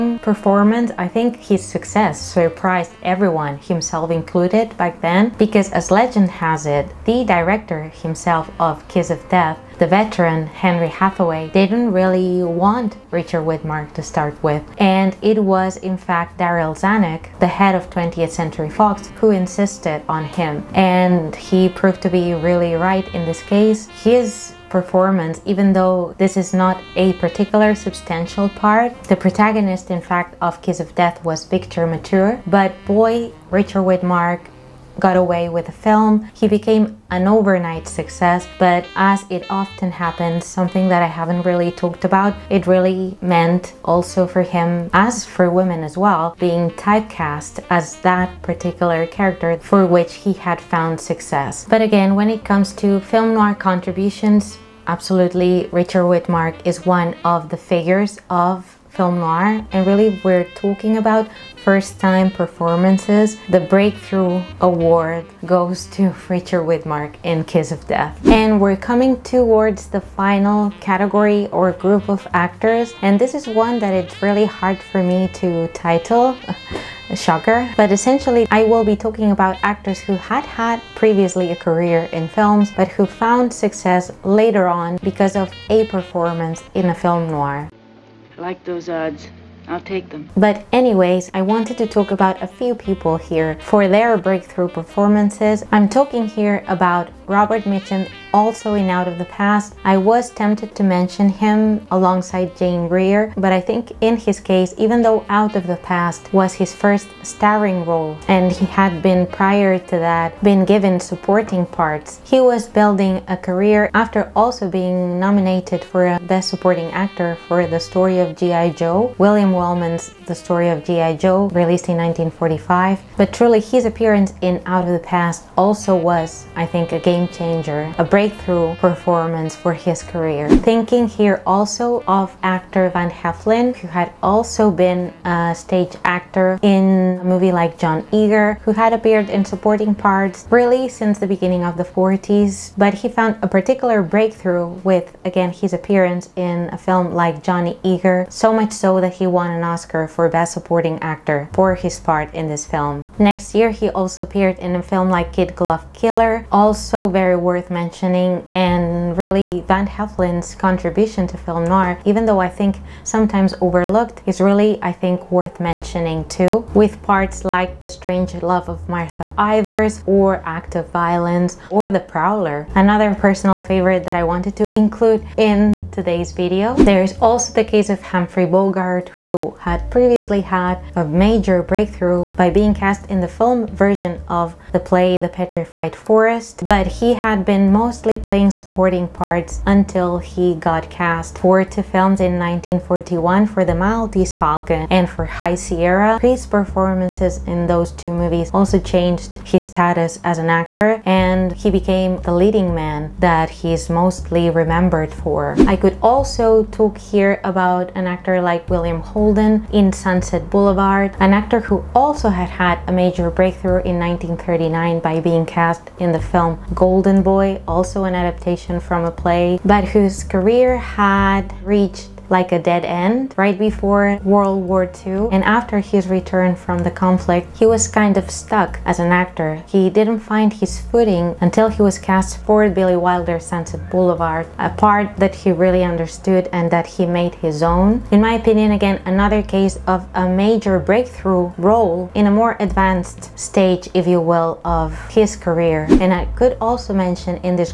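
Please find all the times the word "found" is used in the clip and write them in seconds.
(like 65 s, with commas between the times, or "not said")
50 s, 83 s, 143 s.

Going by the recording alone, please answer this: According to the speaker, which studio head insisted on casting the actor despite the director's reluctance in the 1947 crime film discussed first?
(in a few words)
Darryl Zanuck.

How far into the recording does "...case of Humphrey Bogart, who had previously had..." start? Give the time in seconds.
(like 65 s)
177 s.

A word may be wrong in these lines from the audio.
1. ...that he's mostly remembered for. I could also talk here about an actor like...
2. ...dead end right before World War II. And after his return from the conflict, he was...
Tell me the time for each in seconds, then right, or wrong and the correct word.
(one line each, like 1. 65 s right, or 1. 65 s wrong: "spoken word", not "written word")
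1. 203 s right
2. 222 s right.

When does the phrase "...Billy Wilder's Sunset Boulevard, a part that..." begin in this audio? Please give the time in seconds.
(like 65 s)
232 s.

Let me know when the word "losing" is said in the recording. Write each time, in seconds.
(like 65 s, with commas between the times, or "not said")
not said.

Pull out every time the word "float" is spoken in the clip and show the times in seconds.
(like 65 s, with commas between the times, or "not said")
not said.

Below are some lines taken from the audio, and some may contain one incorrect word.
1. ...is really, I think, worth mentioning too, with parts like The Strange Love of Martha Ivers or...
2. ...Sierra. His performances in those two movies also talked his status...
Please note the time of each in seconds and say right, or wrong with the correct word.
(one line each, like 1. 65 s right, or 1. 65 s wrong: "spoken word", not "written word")
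1. 164 s right
2. 195 s wrong: "changed", not "talked".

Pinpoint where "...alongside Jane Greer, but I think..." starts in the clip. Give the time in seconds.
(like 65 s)
101 s.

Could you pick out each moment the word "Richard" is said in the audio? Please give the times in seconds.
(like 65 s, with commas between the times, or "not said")
13 s, 33 s, 55 s, 66 s.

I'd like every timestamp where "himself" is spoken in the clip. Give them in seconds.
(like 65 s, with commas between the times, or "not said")
3 s, 8 s.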